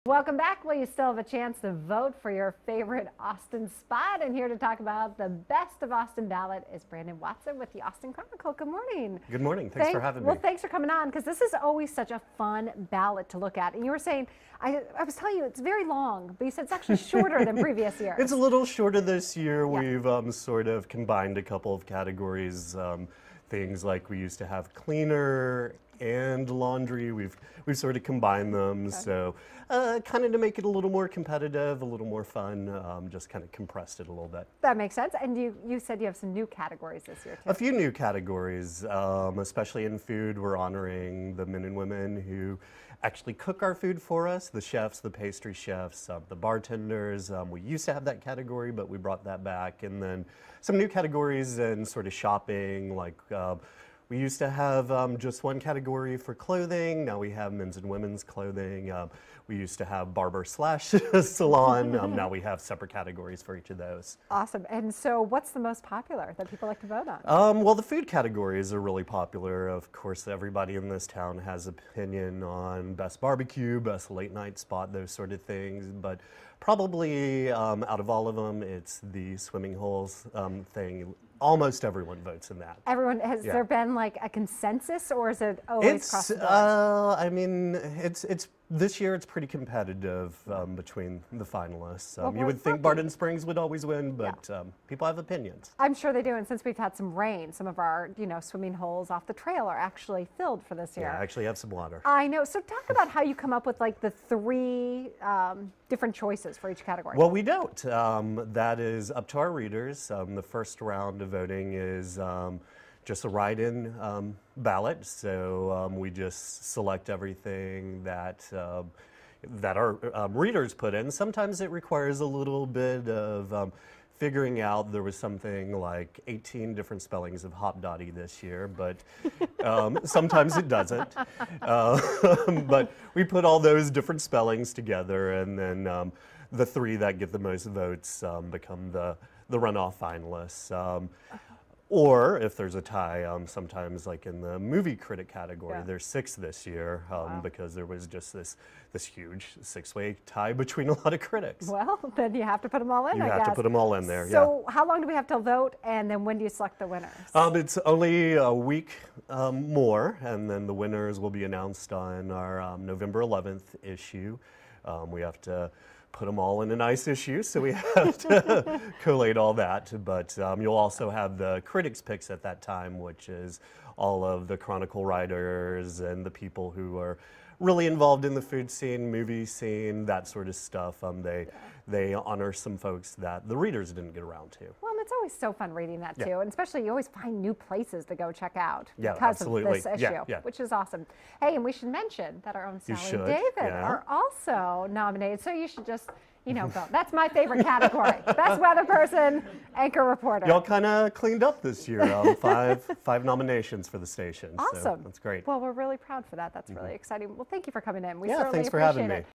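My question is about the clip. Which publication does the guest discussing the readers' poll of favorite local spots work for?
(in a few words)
Austin Chronicle.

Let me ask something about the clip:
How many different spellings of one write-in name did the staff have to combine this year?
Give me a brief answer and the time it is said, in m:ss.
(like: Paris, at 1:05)
18, at 2:06.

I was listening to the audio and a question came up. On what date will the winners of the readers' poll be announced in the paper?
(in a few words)
November 11.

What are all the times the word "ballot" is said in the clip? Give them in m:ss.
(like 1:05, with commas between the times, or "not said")
0:06, 0:12, 1:54.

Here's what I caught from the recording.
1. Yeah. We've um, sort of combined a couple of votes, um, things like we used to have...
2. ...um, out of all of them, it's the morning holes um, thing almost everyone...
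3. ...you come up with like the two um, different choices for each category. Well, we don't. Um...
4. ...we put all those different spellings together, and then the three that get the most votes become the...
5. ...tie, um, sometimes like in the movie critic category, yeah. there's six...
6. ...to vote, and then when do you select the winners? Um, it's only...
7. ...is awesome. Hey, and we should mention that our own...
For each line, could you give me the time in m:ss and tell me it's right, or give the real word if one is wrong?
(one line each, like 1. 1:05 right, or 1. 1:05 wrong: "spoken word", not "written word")
1. 0:19 wrong: "categories", not "votes"
2. 1:17 wrong: "swimming", not "morning"
3. 1:43 wrong: "three", not "two"
4. 2:13 right
5. 2:22 right
6. 2:35 right
7. 3:10 right.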